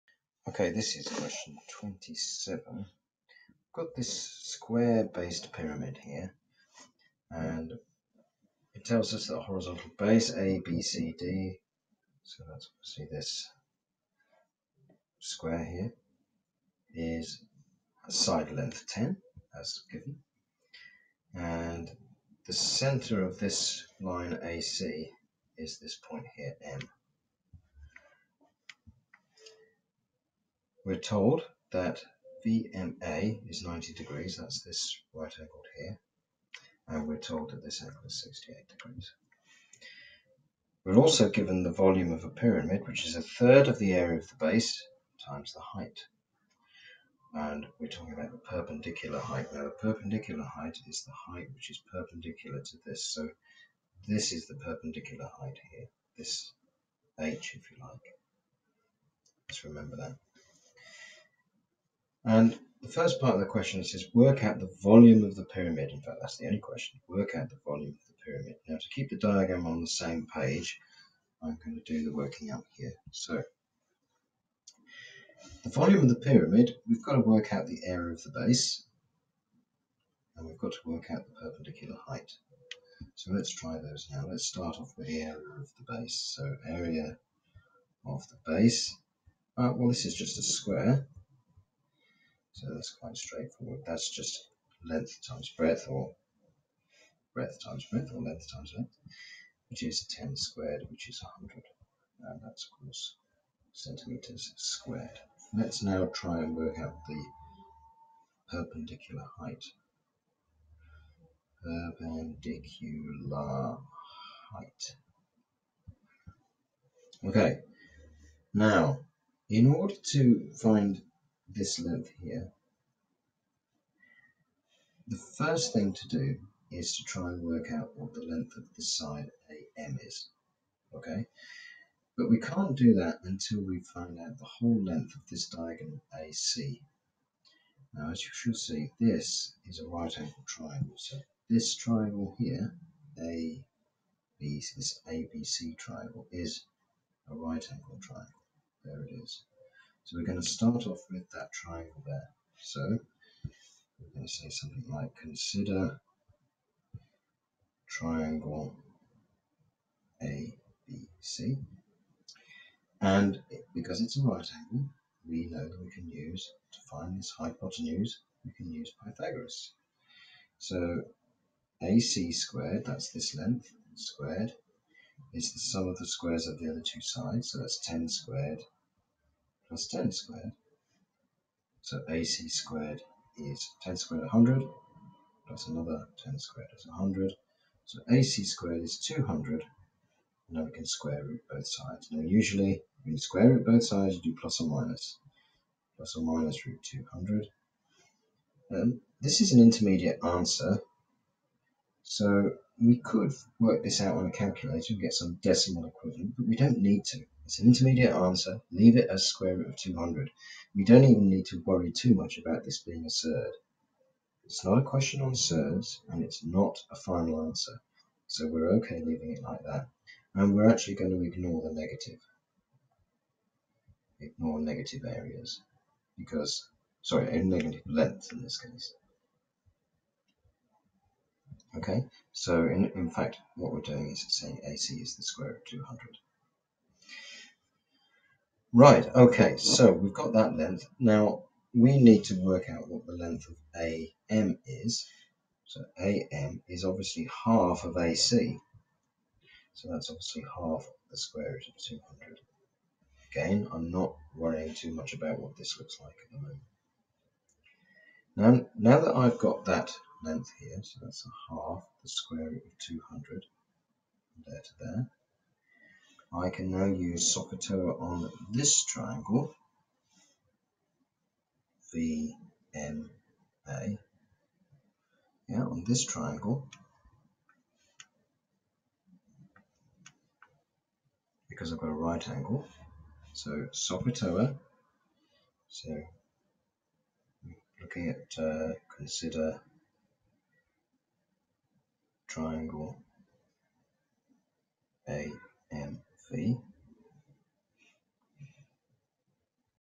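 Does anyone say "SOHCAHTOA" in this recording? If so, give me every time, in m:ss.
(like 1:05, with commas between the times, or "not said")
4:27, 4:43.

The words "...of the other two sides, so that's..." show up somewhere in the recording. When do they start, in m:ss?
2:56.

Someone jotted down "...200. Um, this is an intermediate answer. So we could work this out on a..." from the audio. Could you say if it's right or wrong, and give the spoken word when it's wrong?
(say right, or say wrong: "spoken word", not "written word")
right.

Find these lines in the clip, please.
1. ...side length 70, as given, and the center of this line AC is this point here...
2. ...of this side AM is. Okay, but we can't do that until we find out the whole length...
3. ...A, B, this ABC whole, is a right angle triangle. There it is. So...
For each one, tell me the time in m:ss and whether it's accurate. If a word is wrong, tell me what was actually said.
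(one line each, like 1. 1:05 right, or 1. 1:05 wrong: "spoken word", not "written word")
1. 0:18 wrong: "10", not "70"
2. 2:08 right
3. 2:23 wrong: "triangle", not "whole".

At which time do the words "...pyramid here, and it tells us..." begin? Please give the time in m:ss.
0:05.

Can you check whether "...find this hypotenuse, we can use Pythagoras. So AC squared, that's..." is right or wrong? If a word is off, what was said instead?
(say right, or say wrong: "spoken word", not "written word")
right.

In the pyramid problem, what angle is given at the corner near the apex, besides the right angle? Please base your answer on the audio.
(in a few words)
68 degrees.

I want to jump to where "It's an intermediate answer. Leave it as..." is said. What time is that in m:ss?
3:27.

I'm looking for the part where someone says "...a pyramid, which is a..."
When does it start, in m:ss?
0:42.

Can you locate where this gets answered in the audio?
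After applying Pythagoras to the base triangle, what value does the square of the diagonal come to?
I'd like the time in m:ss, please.
3:08.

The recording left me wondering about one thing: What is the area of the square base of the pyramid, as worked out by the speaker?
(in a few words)
100.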